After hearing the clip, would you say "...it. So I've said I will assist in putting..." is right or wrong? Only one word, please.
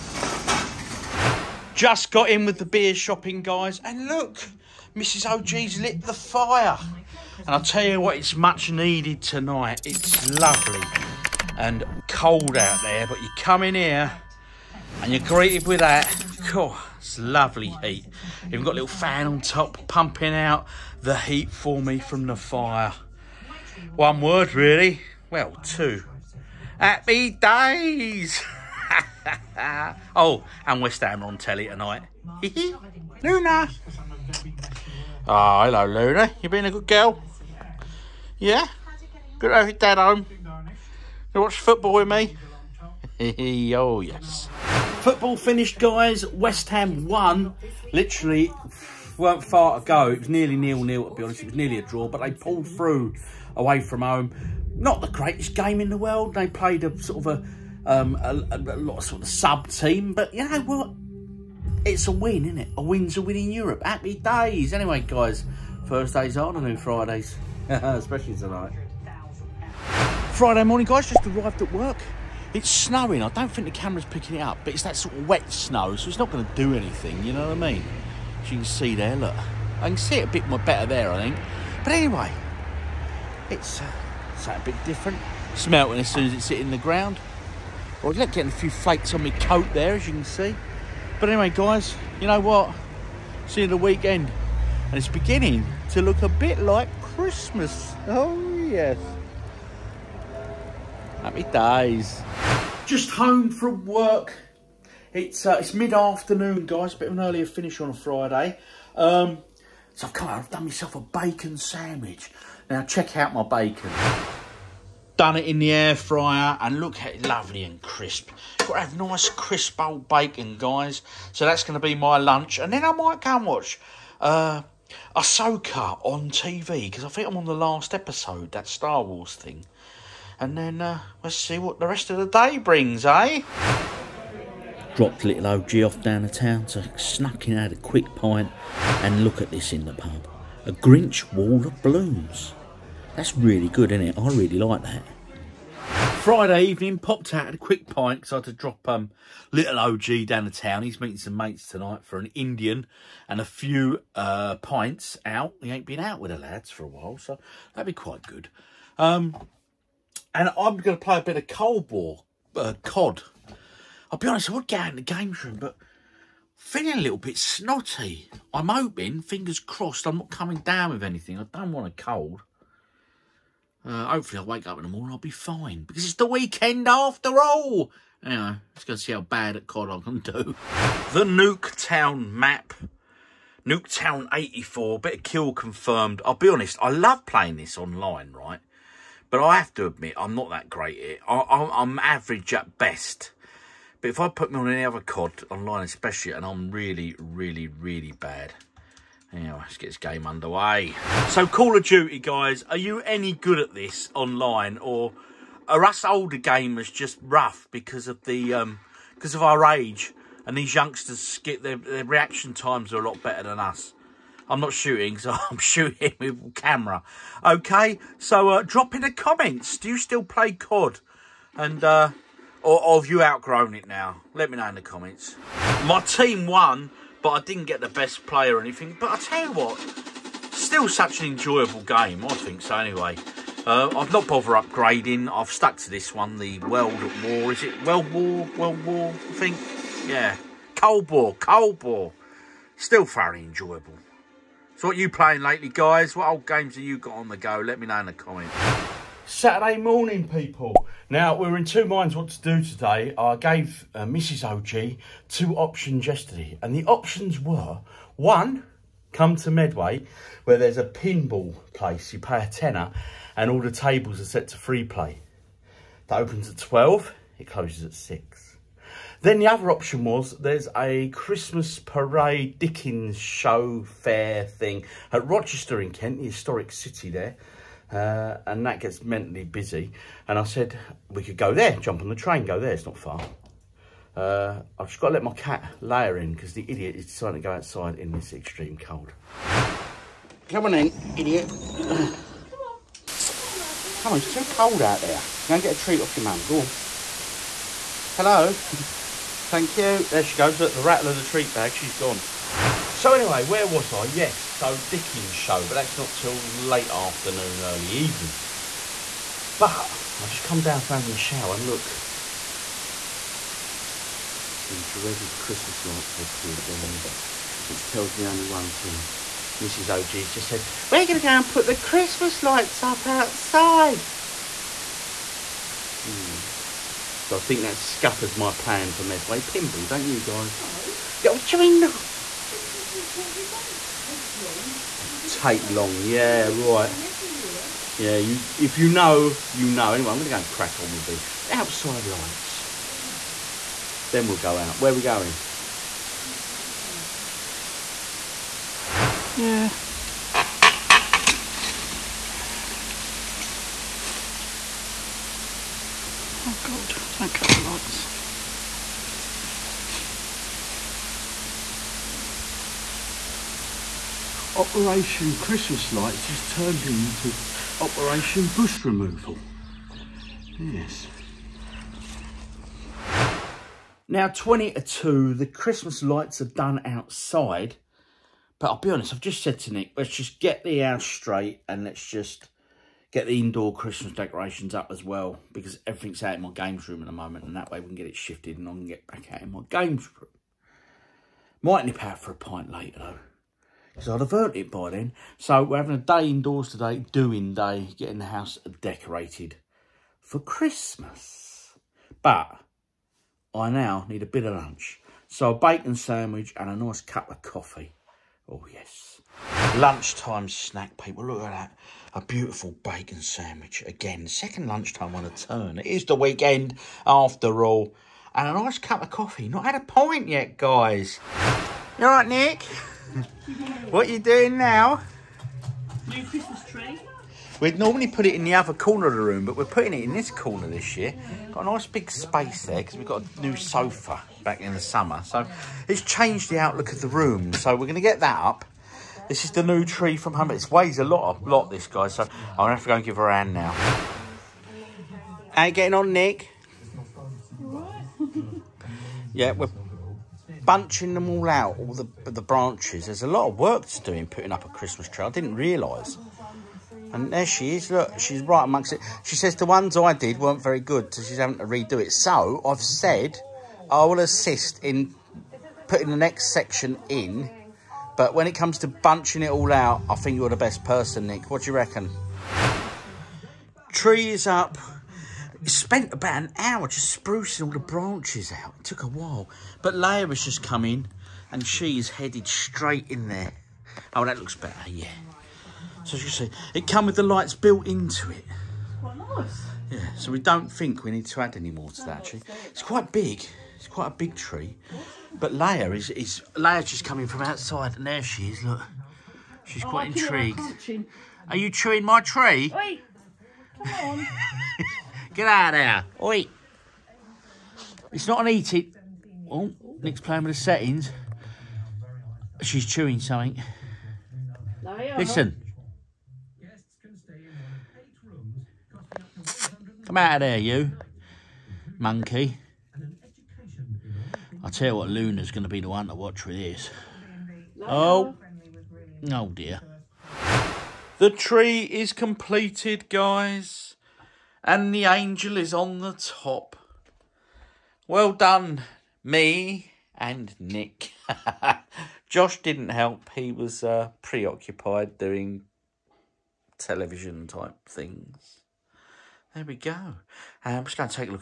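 right.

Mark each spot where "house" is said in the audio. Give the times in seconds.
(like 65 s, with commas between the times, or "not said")
380 s, 398 s.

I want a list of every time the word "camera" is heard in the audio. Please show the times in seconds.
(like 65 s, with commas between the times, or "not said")
73 s, 216 s.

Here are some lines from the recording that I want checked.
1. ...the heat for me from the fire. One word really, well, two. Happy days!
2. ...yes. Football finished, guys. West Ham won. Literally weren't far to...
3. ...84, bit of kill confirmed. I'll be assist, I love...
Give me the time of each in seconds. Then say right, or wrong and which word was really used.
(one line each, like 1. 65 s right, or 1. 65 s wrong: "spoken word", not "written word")
1. 21 s right
2. 44 s right
3. 184 s wrong: "honest", not "assist".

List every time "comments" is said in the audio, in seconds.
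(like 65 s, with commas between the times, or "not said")
219 s, 224 s, 248 s.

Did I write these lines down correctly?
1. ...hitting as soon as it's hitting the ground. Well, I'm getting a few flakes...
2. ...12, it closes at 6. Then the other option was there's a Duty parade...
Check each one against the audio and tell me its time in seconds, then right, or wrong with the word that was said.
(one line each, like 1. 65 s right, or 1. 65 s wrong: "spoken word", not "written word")
1. 85 s wrong: "melting", not "hitting"
2. 266 s wrong: "Christmas", not "Duty".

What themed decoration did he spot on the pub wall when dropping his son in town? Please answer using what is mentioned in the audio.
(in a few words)
Grinch wall of blooms.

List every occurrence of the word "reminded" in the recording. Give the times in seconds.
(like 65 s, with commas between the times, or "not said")
not said.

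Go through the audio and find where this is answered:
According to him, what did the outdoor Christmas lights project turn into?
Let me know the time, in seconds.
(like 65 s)
367 s.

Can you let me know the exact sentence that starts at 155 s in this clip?
He ain't been out with the lads for a while, so that'd be quite good.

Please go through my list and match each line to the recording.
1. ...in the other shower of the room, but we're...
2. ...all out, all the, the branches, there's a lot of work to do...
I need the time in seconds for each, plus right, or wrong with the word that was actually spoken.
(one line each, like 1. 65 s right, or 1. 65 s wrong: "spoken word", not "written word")
1. 428 s wrong: "corner", not "shower"
2. 451 s right.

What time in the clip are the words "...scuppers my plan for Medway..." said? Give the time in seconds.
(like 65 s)
327 s.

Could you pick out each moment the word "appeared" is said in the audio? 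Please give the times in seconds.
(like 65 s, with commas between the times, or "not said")
316 s.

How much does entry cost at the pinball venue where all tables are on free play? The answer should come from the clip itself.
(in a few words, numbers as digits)
a tenner.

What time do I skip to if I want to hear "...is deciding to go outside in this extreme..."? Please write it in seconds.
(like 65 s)
286 s.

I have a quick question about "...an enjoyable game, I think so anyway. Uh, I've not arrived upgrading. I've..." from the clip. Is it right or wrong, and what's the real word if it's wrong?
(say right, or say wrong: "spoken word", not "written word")
wrong: "bothered", not "arrived".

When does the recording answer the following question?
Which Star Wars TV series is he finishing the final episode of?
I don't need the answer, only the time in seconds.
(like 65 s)
125 s.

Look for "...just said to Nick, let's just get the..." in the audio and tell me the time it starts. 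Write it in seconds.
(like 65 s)
379 s.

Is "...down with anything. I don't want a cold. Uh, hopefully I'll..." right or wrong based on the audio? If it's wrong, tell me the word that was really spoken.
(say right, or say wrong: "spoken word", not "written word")
right.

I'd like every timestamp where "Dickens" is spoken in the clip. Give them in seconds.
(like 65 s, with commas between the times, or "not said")
272 s, 304 s.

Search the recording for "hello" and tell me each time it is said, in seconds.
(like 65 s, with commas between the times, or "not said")
35 s, 298 s.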